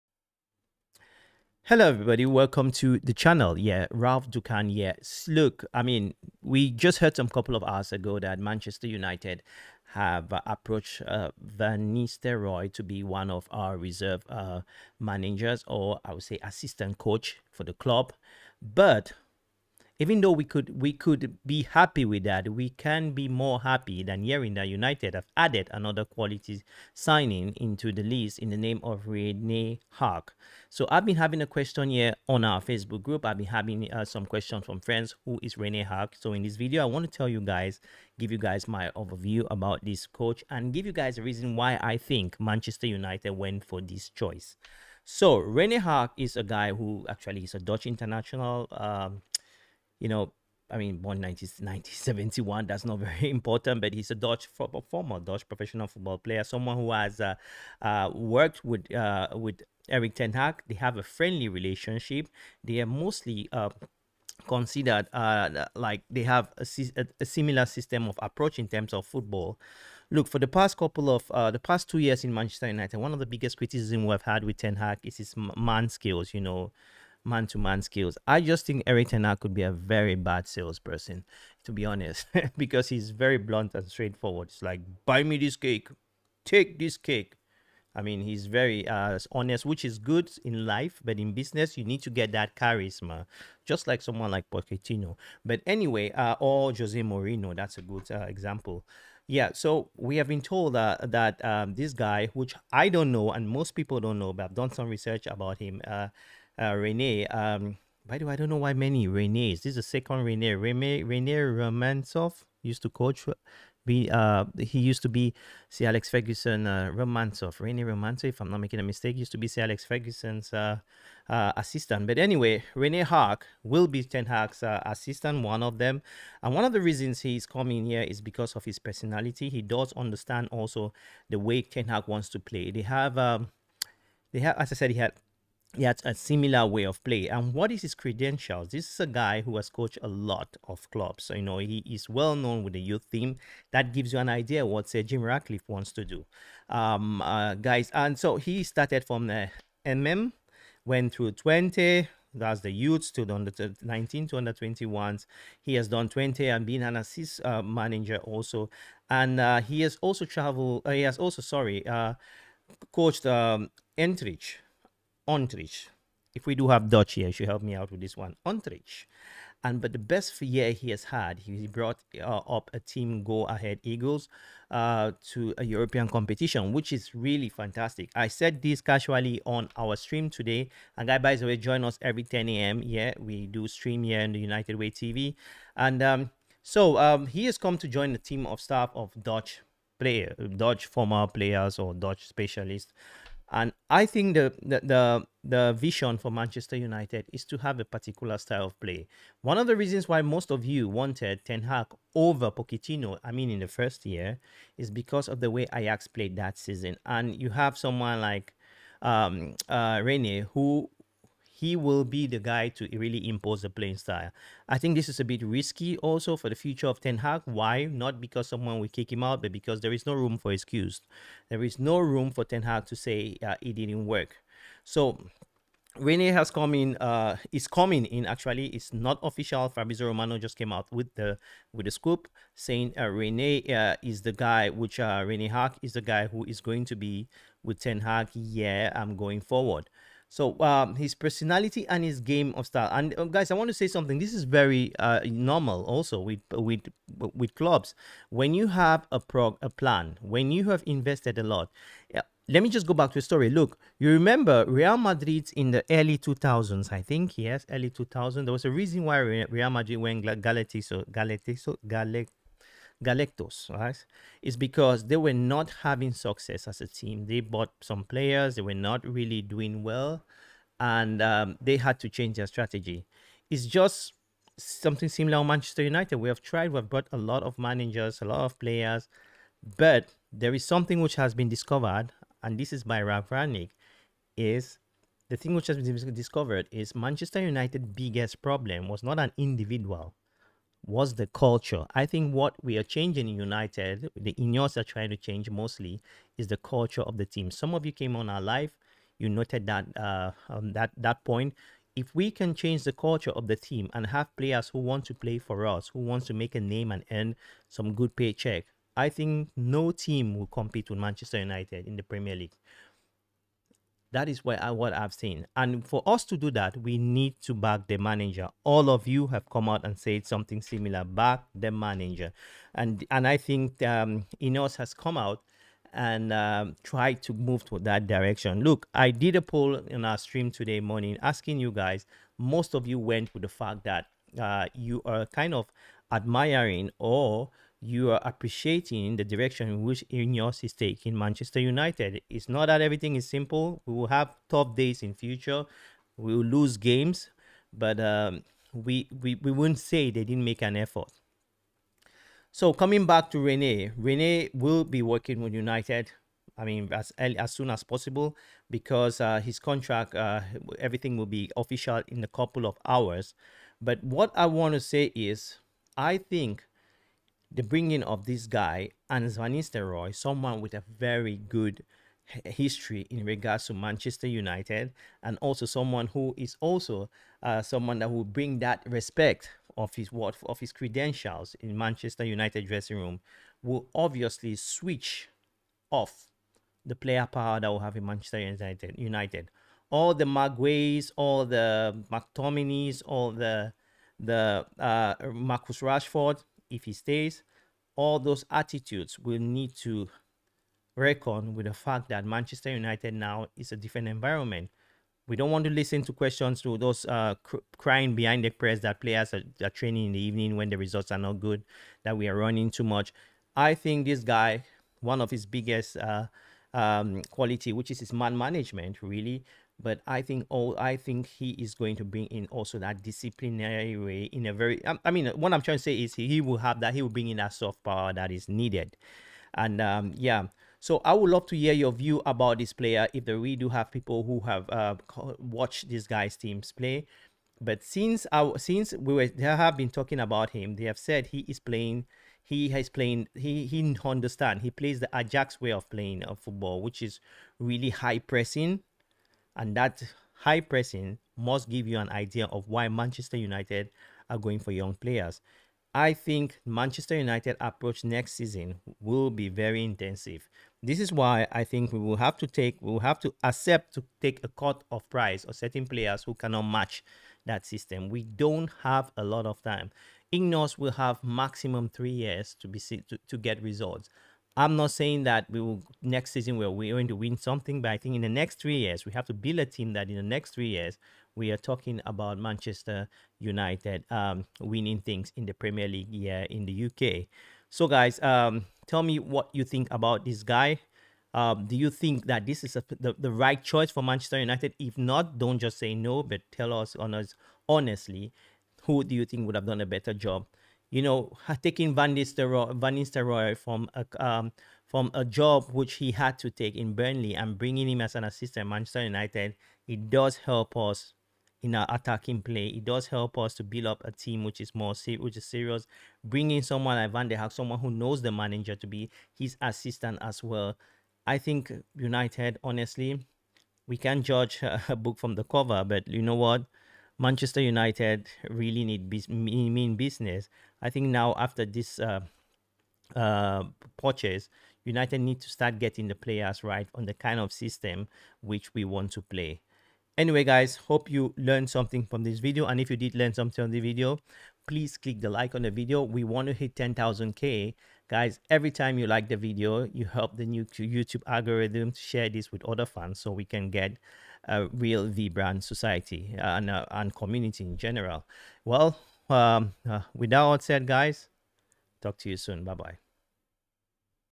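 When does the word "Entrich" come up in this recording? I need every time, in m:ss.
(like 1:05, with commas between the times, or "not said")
2:43.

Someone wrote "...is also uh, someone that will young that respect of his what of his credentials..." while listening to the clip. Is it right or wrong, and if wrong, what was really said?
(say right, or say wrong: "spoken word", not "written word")
wrong: "bring", not "young".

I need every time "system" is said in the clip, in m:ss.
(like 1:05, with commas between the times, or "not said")
1:07, 7:47, 8:57.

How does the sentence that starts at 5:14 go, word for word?
That is where I, uh, what I've seen.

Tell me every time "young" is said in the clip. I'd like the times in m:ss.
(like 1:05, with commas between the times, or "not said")
7:34.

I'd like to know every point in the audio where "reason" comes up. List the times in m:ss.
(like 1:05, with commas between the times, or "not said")
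0:41, 2:06, 3:19, 4:18.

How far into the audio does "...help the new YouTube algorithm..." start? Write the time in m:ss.
9:10.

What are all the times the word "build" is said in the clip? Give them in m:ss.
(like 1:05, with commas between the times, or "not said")
7:59, 8:33.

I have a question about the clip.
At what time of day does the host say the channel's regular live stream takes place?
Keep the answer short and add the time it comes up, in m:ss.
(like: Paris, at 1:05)
10 a.m., at 3:02.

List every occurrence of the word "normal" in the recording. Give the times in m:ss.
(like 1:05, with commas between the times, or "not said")
4:05.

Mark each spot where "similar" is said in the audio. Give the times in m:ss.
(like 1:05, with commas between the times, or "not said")
1:07, 2:16, 4:35, 5:20.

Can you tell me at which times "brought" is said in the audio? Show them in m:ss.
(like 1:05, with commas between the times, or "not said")
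2:51, 4:36.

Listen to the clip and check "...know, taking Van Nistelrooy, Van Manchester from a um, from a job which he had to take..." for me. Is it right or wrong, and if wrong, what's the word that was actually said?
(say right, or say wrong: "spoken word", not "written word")
wrong: "Nistelrooy", not "Manchester".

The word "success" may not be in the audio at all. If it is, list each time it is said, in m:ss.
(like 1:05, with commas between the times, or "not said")
4:26.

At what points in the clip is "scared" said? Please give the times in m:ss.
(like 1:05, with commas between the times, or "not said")
not said.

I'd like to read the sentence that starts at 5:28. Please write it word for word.
Look, I did a poll in our stream today morning asking you guys.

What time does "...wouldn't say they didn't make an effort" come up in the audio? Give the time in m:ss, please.
5:49.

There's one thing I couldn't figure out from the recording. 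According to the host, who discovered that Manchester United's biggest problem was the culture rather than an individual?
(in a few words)
Ralf Rangnick.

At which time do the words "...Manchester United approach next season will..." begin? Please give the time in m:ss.
7:36.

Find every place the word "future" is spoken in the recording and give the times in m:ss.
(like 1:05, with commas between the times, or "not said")
3:36, 5:45.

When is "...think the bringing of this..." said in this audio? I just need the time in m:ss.
6:06.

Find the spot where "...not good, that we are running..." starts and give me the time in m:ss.
6:51.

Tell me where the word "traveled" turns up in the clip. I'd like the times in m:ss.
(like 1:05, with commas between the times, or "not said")
2:40.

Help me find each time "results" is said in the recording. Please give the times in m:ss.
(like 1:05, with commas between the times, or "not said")
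6:50, 7:53.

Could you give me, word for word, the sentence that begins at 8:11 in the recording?
Um, do you think that this is a, the, the right choice for Manchester United?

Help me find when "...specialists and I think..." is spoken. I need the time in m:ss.
3:12.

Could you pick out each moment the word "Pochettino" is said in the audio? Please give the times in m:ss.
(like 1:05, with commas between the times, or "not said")
1:34, 3:22.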